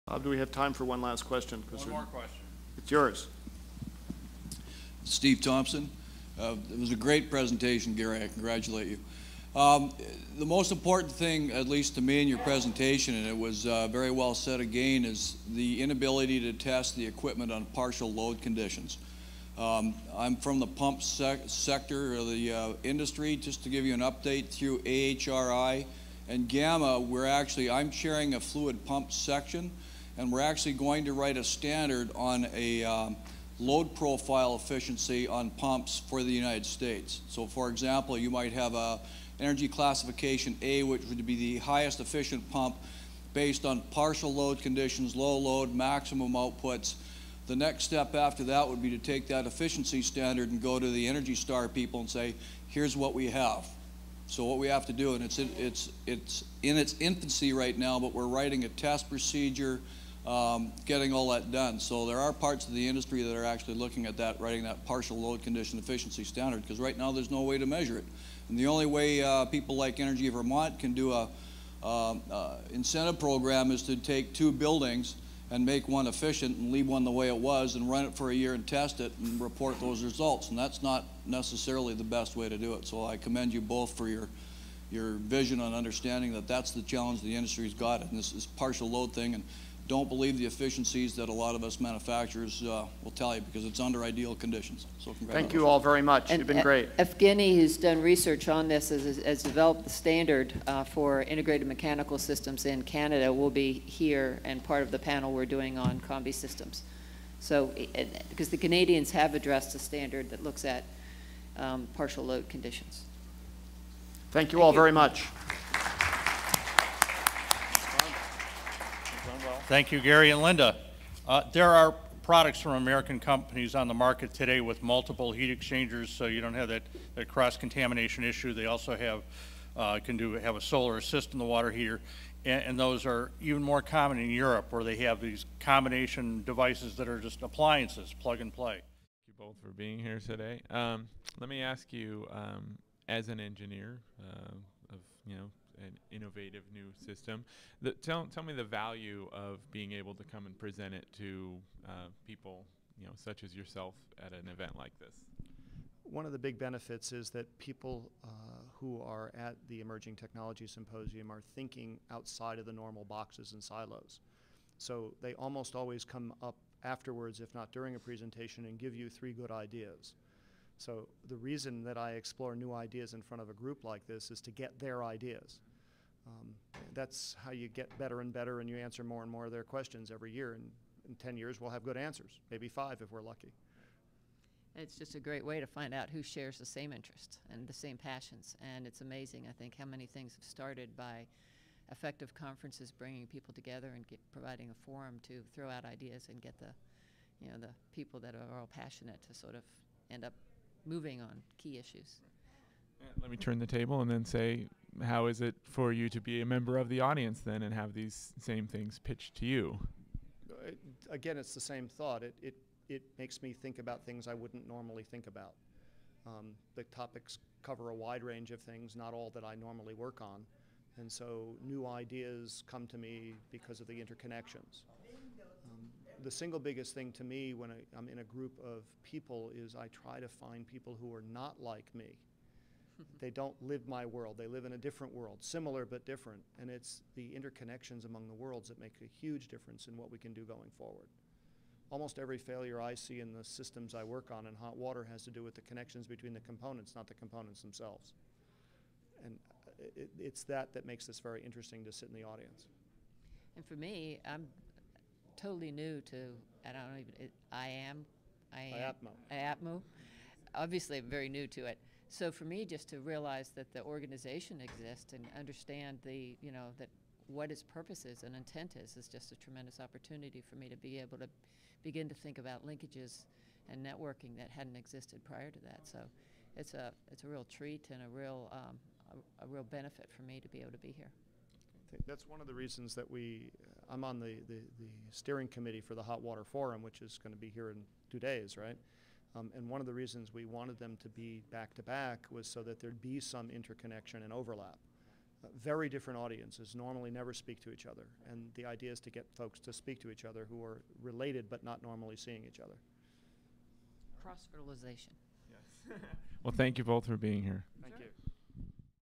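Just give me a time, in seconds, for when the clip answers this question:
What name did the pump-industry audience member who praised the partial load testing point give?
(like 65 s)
5 s.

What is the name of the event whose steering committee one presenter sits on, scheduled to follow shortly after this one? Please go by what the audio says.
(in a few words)
Hot Water Forum.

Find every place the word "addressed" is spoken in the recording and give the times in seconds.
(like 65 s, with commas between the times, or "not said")
109 s.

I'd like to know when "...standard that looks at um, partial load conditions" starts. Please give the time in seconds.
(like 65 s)
109 s.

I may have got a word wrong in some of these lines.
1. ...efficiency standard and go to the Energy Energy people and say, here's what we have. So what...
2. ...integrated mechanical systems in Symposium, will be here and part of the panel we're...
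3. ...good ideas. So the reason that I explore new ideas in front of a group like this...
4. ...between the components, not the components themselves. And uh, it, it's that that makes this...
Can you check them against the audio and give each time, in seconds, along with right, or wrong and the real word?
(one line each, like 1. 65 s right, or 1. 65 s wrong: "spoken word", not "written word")
1. 49 s wrong: "Star", not "Energy"
2. 101 s wrong: "Canada", not "Symposium"
3. 169 s right
4. 246 s right.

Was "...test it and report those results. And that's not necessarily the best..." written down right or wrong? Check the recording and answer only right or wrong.
right.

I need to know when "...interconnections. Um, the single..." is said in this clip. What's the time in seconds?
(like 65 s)
223 s.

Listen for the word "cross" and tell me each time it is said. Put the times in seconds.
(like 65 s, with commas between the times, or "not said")
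127 s, 304 s.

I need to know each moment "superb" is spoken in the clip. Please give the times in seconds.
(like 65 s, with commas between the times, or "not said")
not said.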